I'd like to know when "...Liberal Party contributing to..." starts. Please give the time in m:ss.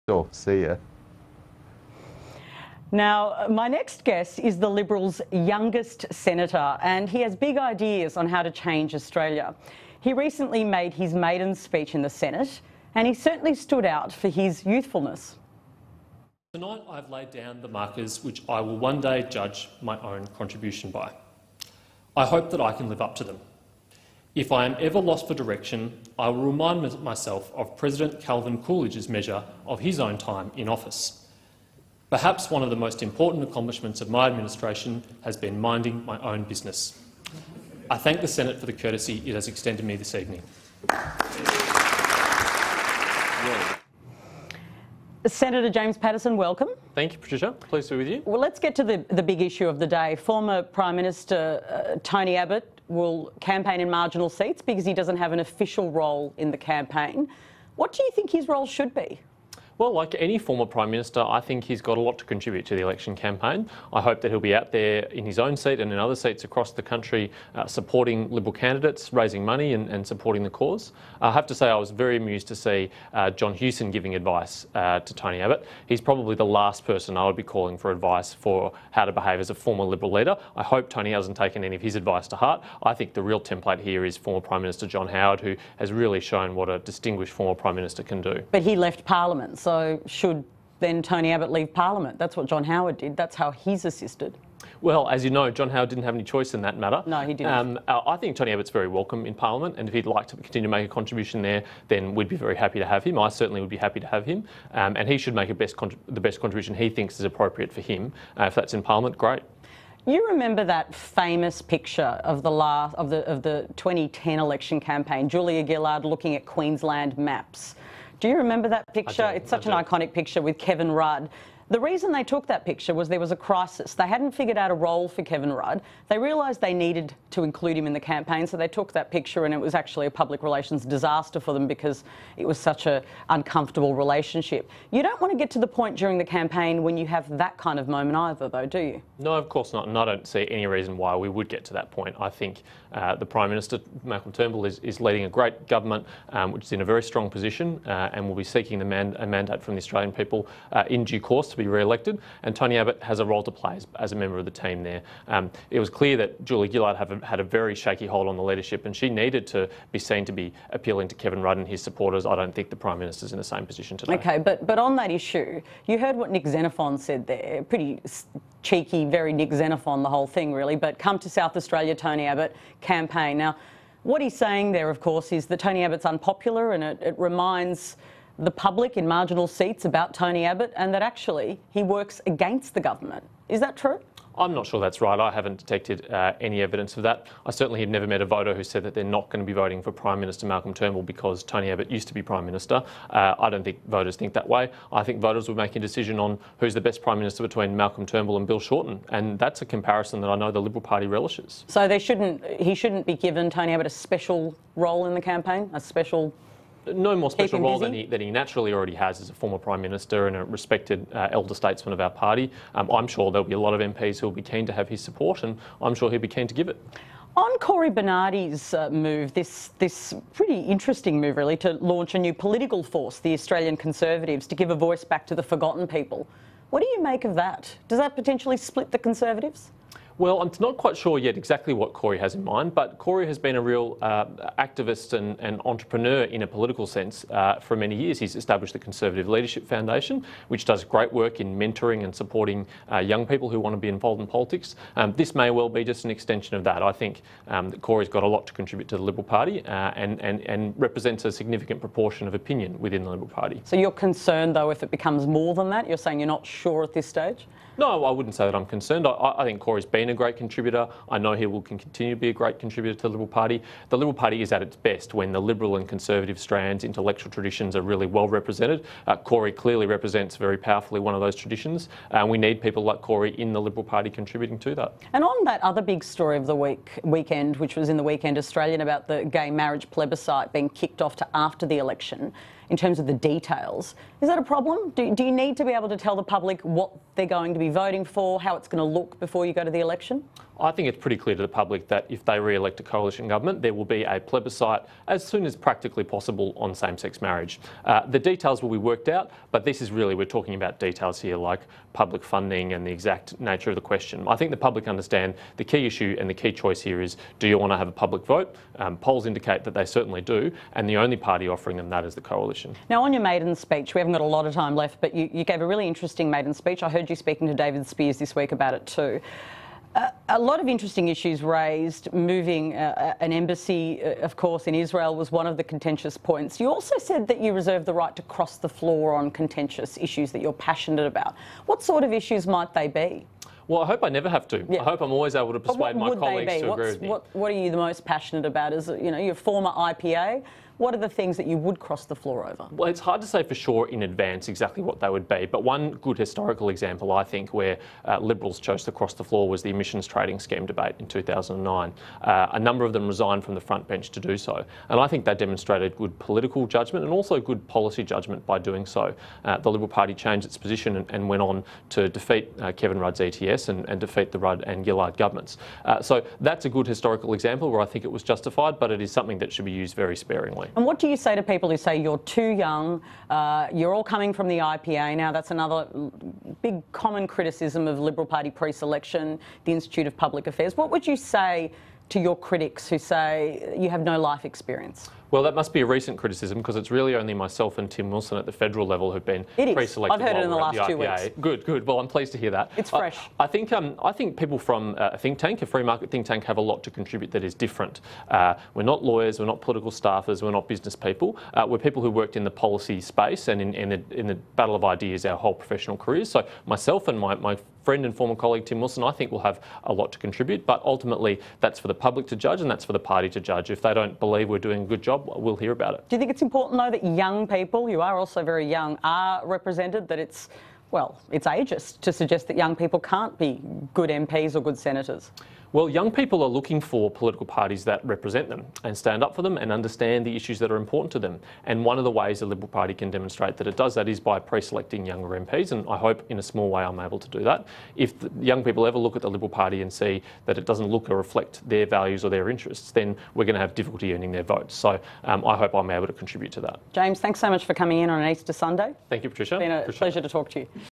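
4:33.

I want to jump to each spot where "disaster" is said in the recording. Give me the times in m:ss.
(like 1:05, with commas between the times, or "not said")
2:10.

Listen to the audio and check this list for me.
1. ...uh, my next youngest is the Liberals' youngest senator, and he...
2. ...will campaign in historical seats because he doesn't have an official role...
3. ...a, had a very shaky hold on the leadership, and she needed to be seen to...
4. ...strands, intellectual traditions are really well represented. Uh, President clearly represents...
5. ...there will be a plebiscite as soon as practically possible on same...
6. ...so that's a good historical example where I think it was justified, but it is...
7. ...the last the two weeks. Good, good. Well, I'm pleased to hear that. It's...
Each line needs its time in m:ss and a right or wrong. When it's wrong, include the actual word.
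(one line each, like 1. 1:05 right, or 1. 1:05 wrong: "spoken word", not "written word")
1. 0:03 wrong: "guest", not "youngest"
2. 0:52 wrong: "marginal", not "historical"
3. 2:37 right
4. 4:26 wrong: "Cory", not "President"
5. 4:53 right
6. 6:06 right
7. 6:30 right.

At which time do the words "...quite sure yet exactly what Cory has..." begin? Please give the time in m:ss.
3:50.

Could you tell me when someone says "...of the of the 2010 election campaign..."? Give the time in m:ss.
1:52.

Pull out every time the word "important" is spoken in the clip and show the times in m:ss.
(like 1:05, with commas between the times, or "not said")
0:33, 6:56, 7:10.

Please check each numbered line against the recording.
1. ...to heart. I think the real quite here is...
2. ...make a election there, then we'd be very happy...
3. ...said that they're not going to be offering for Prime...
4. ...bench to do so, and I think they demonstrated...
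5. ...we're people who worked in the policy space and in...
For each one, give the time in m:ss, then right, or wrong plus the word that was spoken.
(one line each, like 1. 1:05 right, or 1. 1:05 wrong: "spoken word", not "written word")
1. 1:22 wrong: "template", not "quite"
2. 1:40 wrong: "contribution", not "election"
3. 3:08 wrong: "voting", not "offering"
4. 5:53 right
5. 6:41 right.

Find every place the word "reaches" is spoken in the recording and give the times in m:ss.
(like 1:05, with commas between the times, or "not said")
not said.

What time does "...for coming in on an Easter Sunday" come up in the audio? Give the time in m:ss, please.
7:27.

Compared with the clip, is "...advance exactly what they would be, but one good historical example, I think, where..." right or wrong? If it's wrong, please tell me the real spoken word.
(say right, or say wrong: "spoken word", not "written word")
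right.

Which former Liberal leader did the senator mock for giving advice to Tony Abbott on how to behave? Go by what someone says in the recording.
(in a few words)
John Hewson.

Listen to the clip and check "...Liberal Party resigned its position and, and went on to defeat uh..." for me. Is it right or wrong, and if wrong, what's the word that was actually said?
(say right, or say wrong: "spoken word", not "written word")
wrong: "changed", not "resigned".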